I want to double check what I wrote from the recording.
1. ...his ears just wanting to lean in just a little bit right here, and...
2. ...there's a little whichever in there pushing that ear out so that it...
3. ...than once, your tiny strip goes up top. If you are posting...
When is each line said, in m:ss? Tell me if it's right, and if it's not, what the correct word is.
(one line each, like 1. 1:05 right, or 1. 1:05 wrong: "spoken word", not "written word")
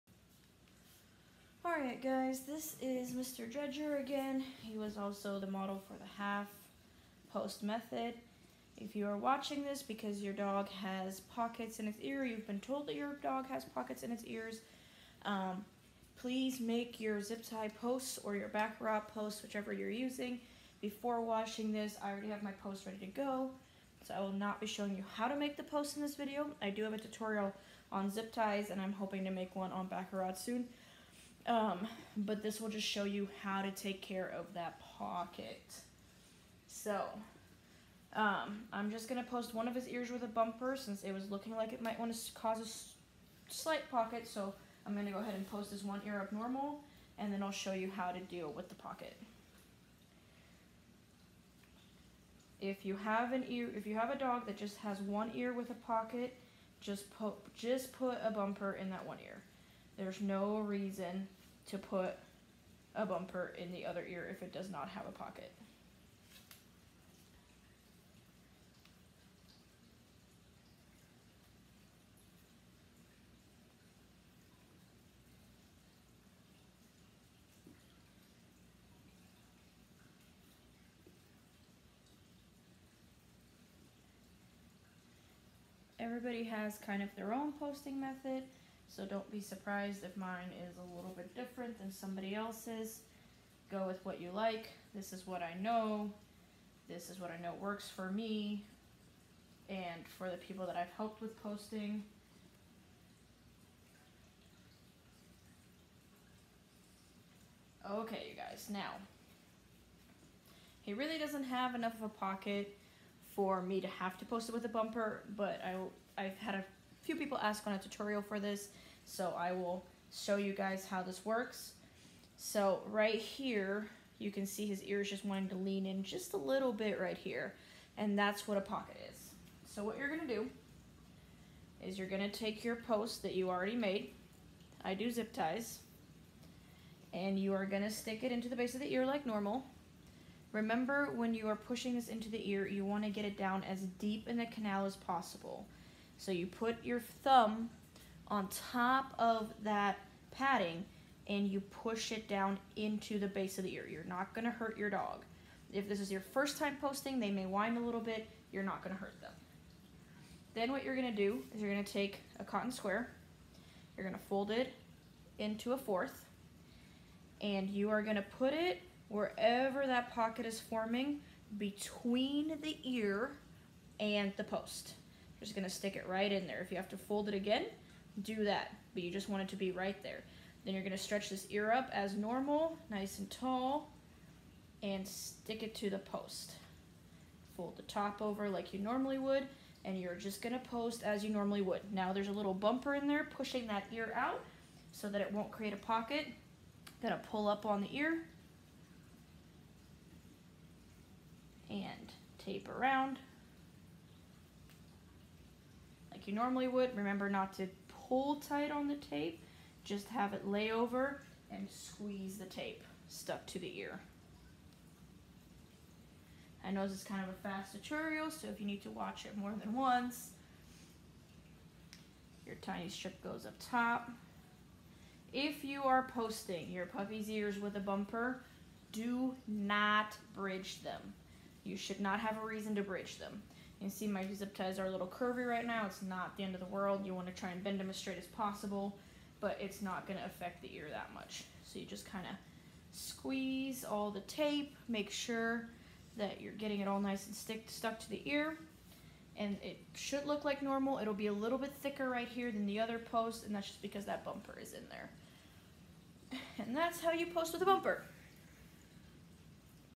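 1. 2:04 right
2. 3:12 wrong: "bumper", not "whichever"
3. 3:39 right.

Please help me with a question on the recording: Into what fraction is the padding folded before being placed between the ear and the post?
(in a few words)
a fourth.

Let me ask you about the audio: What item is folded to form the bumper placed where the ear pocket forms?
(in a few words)
cotton square.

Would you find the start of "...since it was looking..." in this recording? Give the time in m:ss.
0:40.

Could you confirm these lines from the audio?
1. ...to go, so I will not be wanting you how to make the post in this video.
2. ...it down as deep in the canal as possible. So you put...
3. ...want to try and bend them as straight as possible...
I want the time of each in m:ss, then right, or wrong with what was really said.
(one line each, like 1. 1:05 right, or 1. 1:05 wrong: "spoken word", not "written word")
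1. 0:22 wrong: "showing", not "wanting"
2. 2:23 right
3. 3:57 right.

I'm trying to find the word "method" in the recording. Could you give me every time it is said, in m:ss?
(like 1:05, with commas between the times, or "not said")
0:07, 1:28.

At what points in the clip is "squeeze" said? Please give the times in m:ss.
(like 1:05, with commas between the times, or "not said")
3:31, 4:02.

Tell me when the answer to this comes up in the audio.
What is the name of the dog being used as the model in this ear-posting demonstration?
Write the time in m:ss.
0:03.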